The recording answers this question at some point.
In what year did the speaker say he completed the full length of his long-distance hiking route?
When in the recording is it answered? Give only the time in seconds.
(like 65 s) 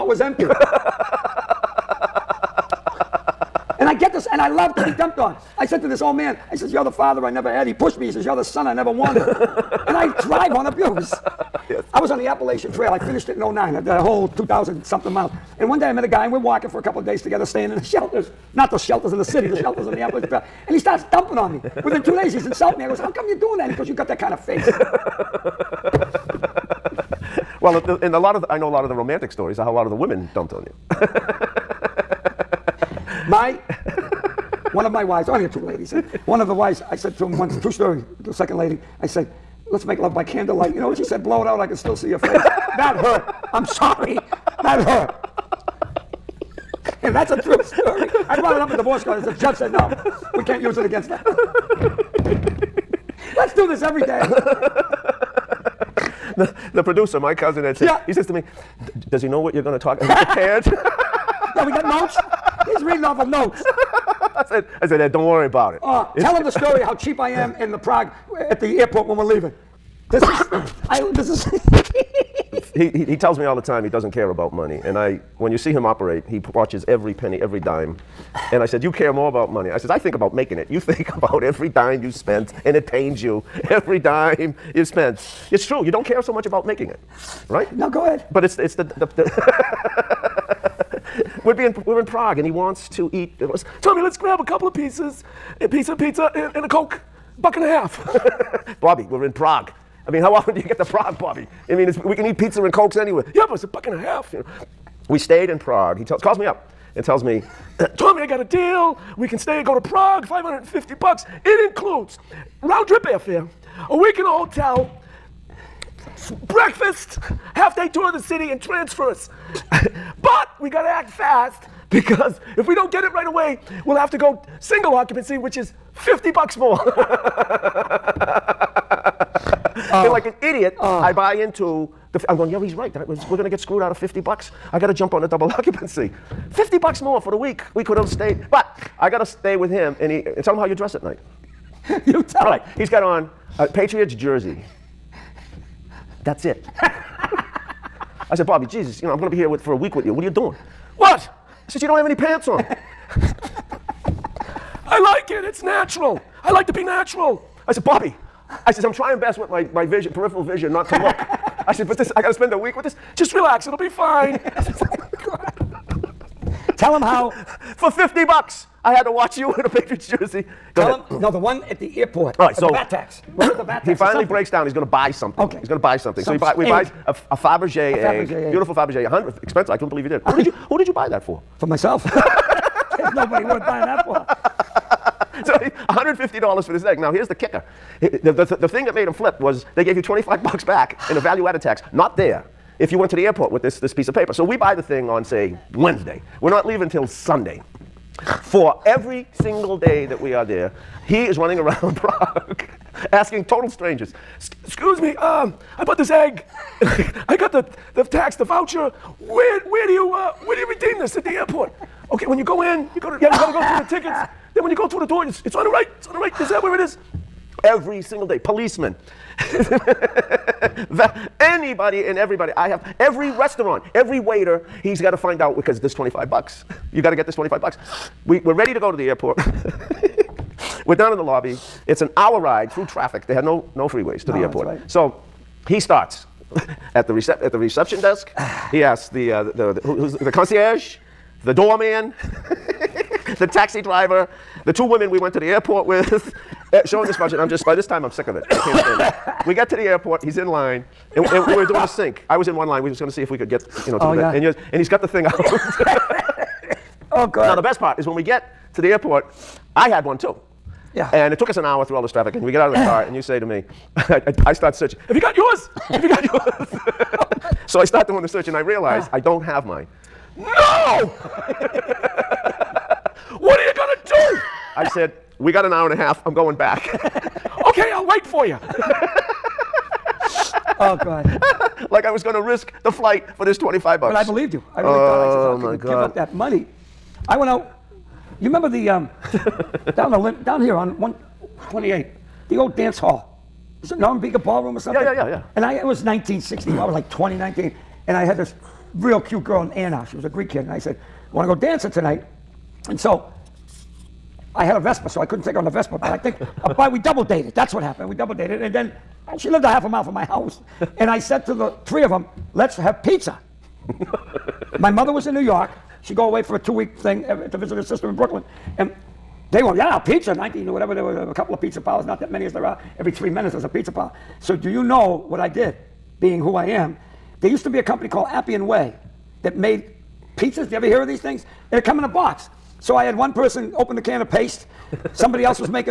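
13 s.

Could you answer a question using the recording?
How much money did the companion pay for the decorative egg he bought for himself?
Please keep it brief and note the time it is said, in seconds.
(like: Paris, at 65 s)
$150, at 185 s.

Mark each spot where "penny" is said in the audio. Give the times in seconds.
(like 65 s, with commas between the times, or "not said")
77 s.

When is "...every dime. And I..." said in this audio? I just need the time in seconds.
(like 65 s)
77 s.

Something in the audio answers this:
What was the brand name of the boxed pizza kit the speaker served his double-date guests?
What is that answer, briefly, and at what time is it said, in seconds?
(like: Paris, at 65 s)
Appian Way, at 328 s.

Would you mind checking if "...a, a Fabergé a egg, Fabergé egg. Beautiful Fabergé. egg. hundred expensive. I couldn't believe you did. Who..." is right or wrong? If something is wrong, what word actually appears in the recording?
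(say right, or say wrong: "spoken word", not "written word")
right.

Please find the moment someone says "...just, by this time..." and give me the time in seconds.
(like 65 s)
247 s.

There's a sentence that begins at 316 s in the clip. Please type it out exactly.
She'd go away for a two week thing to visit her sister in Brooklyn.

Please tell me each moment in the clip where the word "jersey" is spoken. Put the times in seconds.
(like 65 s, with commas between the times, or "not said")
144 s, 170 s.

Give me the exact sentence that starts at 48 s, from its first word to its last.
I brought it up in divorce court.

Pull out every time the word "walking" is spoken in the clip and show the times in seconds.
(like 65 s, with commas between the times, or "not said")
16 s.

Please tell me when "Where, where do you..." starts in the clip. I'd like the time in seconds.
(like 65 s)
209 s.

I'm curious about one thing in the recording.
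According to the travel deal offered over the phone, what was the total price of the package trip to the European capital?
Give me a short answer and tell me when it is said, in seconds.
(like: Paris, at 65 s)
$550, at 110 s.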